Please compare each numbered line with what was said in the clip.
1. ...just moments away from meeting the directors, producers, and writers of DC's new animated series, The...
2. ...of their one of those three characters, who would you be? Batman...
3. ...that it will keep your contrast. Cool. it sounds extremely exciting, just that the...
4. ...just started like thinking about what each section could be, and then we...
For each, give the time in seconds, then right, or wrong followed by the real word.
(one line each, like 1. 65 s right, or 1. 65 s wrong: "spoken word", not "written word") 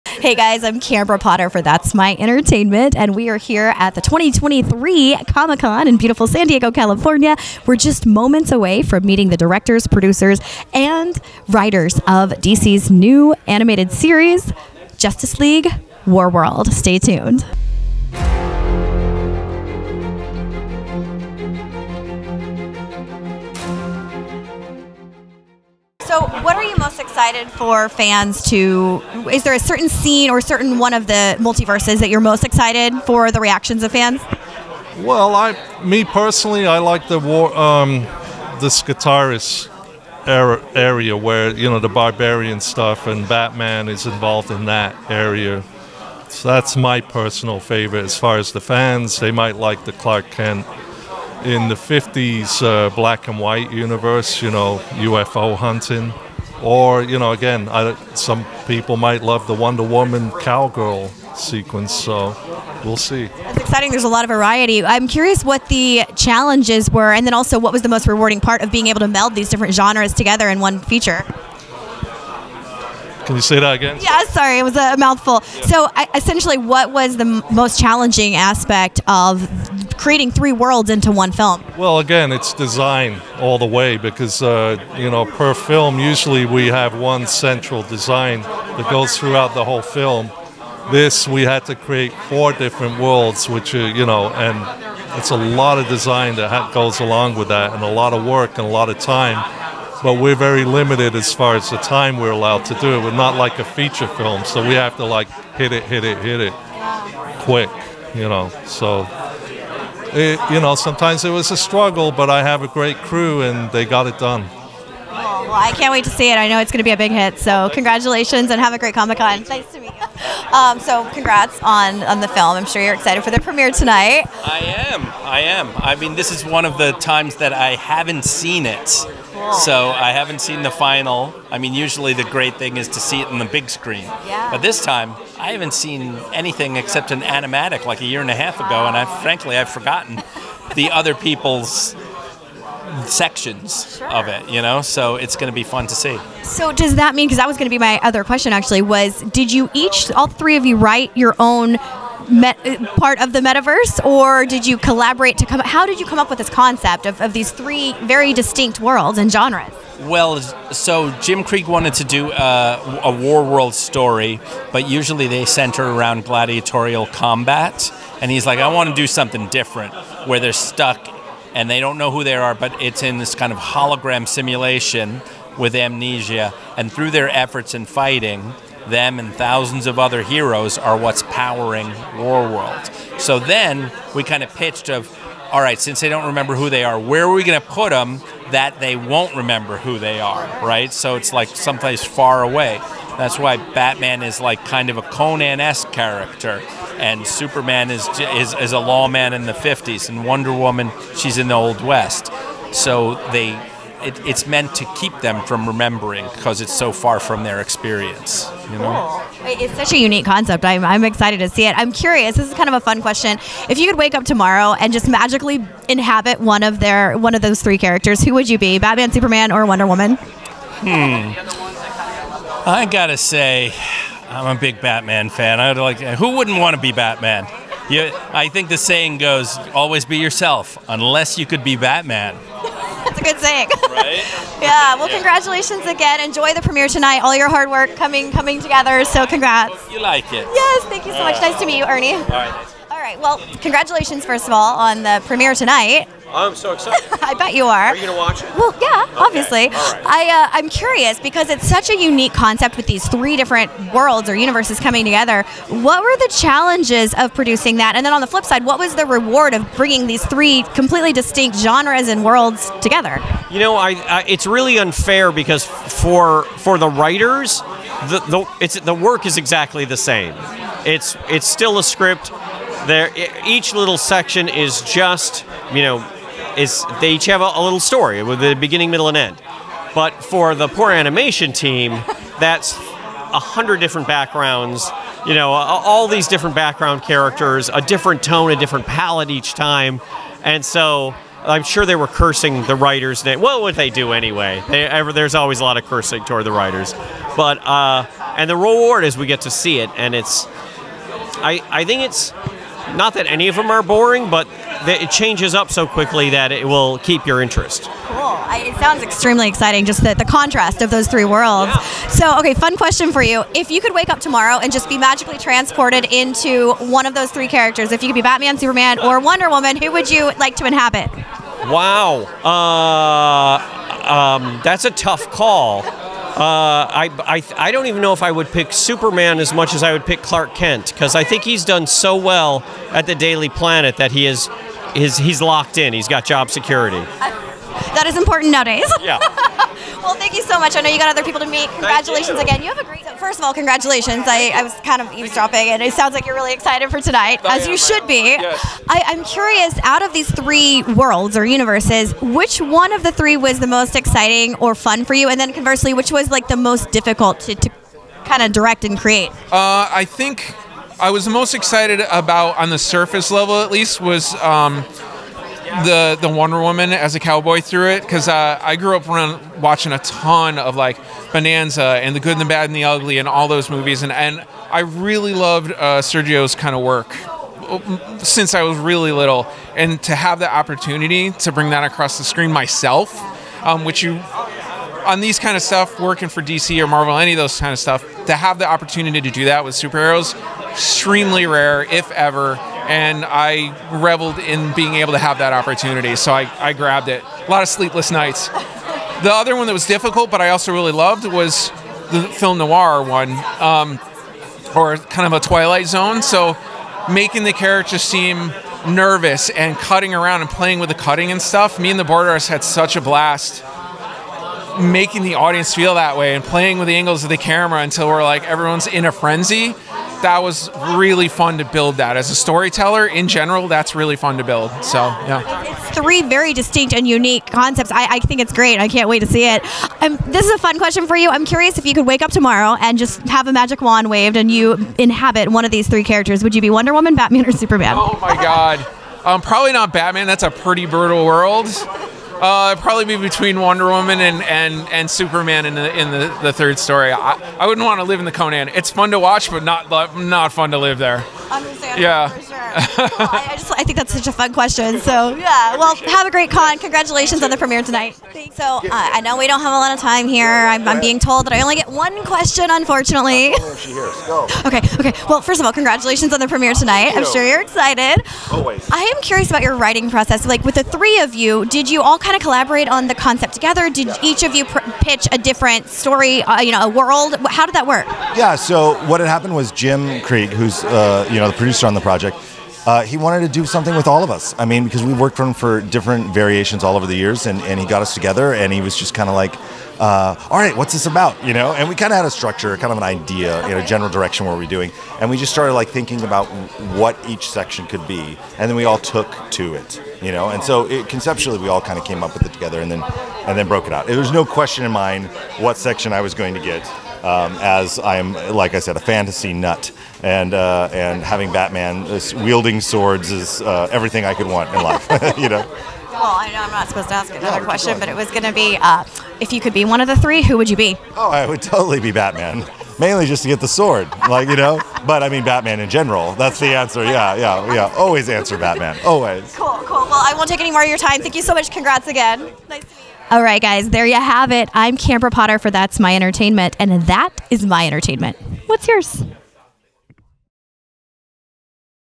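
1. 7 s wrong: "Justice", not "The"
2. 216 s right
3. 306 s wrong: "interest", not "contrast"
4. 495 s right.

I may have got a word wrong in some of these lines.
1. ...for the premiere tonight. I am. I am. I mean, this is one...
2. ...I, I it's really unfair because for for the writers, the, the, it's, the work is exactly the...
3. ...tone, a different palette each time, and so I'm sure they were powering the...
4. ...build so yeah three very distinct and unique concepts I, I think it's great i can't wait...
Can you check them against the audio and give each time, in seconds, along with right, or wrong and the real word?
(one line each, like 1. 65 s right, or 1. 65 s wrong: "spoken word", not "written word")
1. 123 s right
2. 263 s right
3. 288 s wrong: "cursing", not "powering"
4. 424 s right.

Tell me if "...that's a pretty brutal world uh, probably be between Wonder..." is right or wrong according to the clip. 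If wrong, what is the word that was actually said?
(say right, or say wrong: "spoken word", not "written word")
right.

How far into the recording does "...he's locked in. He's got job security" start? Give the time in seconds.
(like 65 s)
335 s.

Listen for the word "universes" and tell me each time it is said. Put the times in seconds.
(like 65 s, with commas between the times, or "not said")
53 s, 254 s, 351 s.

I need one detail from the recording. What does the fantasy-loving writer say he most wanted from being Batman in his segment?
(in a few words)
the sword.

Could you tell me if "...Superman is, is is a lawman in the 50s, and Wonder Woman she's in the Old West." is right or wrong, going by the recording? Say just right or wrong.
right.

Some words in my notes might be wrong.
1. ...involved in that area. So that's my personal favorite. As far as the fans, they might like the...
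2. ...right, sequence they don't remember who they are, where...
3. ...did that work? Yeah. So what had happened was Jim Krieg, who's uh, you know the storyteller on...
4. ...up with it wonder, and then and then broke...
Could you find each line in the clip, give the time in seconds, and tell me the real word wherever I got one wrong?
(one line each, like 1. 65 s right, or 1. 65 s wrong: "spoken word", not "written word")
1. 44 s right
2. 185 s wrong: "since", not "sequence"
3. 477 s wrong: "producer", not "storyteller"
4. 502 s wrong: "together", not "wonder".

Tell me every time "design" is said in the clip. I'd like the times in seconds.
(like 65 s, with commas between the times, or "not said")
82 s, 87 s, 95 s.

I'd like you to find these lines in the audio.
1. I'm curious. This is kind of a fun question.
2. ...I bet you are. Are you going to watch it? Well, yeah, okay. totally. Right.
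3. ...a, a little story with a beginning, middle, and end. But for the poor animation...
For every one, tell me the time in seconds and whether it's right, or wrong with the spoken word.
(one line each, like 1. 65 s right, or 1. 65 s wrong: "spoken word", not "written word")
1. 211 s right
2. 247 s wrong: "obviously", not "totally"
3. 277 s right.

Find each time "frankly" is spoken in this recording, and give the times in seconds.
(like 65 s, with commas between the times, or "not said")
139 s.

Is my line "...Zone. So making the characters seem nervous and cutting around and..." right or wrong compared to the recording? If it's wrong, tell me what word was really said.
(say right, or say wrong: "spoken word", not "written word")
right.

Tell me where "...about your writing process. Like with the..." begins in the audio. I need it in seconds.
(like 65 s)
469 s.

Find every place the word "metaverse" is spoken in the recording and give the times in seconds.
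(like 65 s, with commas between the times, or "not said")
153 s.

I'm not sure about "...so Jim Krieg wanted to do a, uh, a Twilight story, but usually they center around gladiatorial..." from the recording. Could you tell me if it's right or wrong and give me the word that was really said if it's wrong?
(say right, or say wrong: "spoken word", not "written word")
wrong: "Warworld", not "Twilight".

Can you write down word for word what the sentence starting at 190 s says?
So it's like someplace far away.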